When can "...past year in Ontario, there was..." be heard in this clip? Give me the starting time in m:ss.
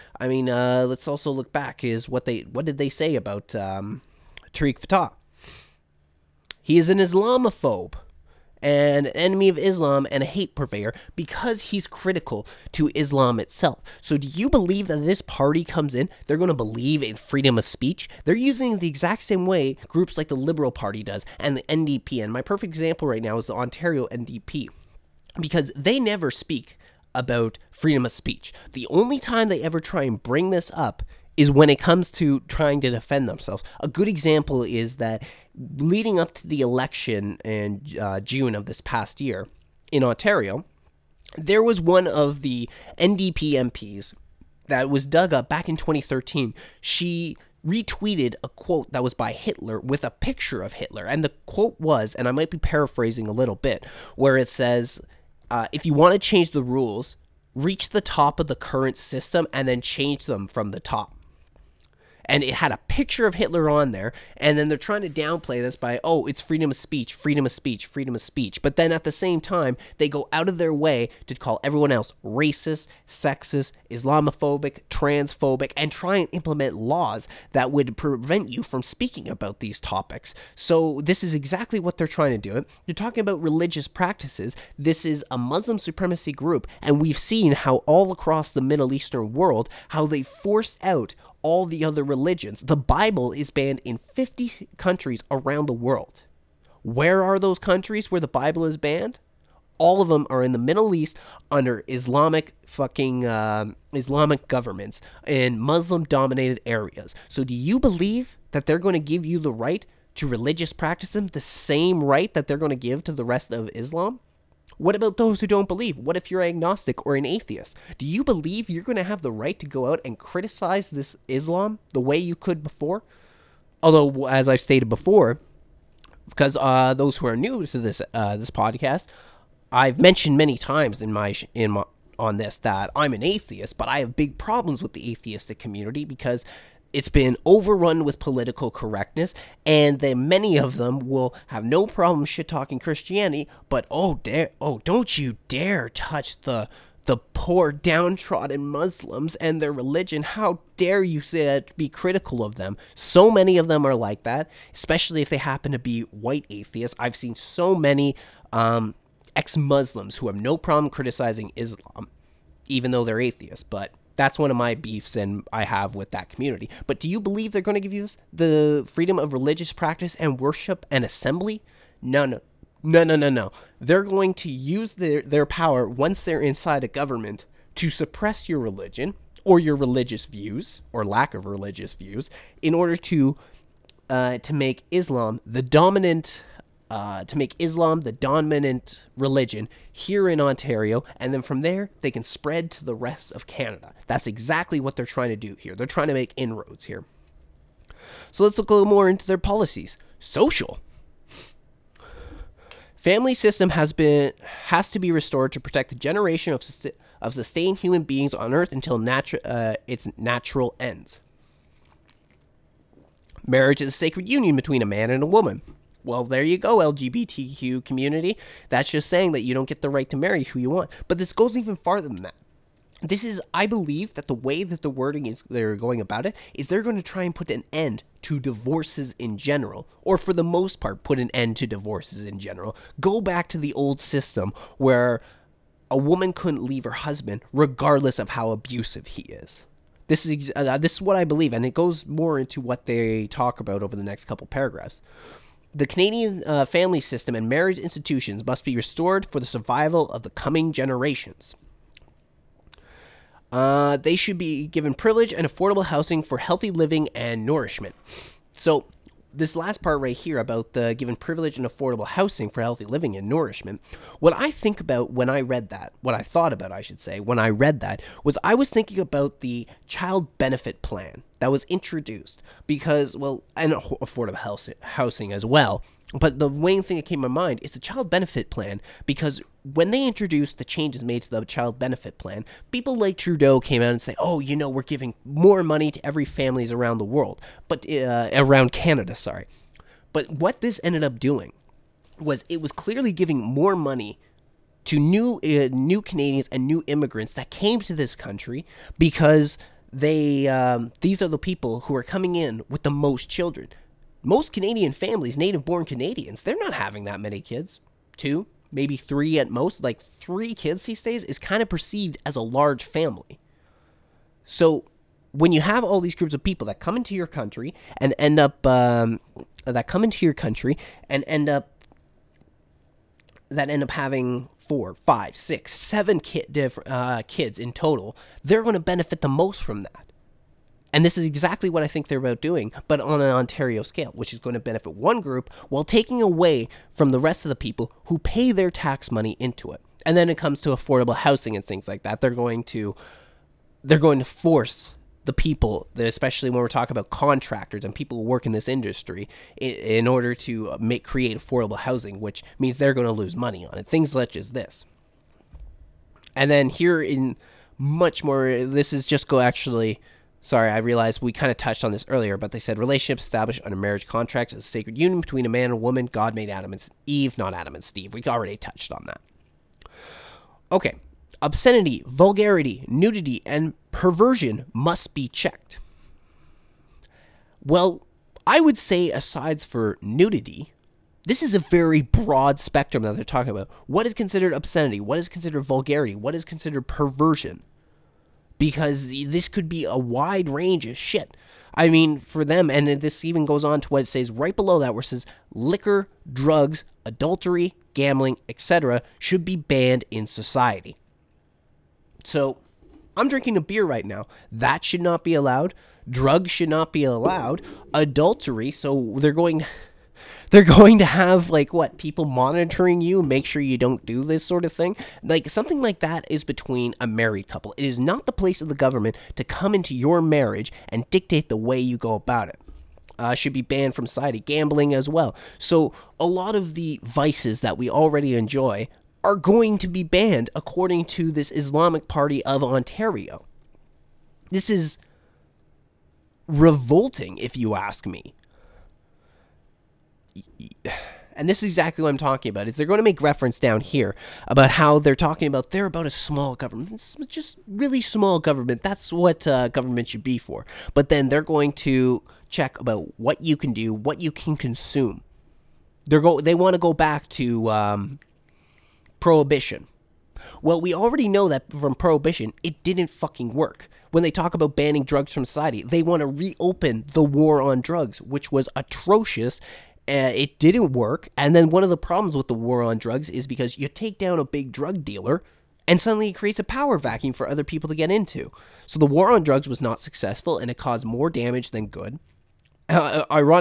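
0:38.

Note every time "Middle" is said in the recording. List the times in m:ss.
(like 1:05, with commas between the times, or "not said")
1:28, 1:40.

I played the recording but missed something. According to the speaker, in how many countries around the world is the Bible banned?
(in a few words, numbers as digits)
50.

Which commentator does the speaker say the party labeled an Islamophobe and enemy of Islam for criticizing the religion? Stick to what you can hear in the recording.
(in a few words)
Tarek Fatah.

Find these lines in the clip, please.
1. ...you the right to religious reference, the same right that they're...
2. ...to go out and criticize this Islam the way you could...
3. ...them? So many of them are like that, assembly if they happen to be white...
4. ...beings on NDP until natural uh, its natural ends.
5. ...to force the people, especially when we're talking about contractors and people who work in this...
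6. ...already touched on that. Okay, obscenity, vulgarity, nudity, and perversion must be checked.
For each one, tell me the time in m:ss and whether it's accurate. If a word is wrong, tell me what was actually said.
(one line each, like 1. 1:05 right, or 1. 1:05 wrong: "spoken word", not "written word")
1. 1:49 wrong: "practice", not "reference"
2. 1:59 right
3. 2:32 wrong: "especially", not "assembly"
4. 3:28 wrong: "Earth", not "NDP"
5. 5:44 right
6. 6:08 right.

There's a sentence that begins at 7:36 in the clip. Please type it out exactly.
They're go they want to go back to um, prohibition.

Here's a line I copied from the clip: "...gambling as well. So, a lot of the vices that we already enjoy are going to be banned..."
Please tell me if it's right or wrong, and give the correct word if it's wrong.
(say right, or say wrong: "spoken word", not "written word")
right.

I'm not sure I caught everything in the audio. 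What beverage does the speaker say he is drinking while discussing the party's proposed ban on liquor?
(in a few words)
beer.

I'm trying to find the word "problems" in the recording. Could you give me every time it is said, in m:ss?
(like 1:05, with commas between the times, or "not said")
2:14, 2:21, 2:40, 7:51.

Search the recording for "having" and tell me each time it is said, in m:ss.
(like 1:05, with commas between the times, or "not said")
5:06, 5:23.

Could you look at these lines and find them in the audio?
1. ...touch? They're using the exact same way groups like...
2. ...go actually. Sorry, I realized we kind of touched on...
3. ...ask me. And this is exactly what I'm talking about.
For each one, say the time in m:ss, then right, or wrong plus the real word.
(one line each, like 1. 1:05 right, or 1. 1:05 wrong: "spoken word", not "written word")
1. 0:17 wrong: "speech", not "touch"
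2. 5:59 right
3. 7:17 right.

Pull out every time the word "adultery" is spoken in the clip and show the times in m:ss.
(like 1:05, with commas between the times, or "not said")
6:37, 6:47.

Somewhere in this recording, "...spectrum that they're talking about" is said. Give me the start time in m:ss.
6:22.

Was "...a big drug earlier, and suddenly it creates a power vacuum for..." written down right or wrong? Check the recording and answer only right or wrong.
wrong.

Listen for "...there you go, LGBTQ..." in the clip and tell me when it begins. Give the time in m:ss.
3:36.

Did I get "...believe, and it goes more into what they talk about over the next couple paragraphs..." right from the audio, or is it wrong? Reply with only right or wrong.
right.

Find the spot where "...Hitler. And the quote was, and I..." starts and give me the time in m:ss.
0:50.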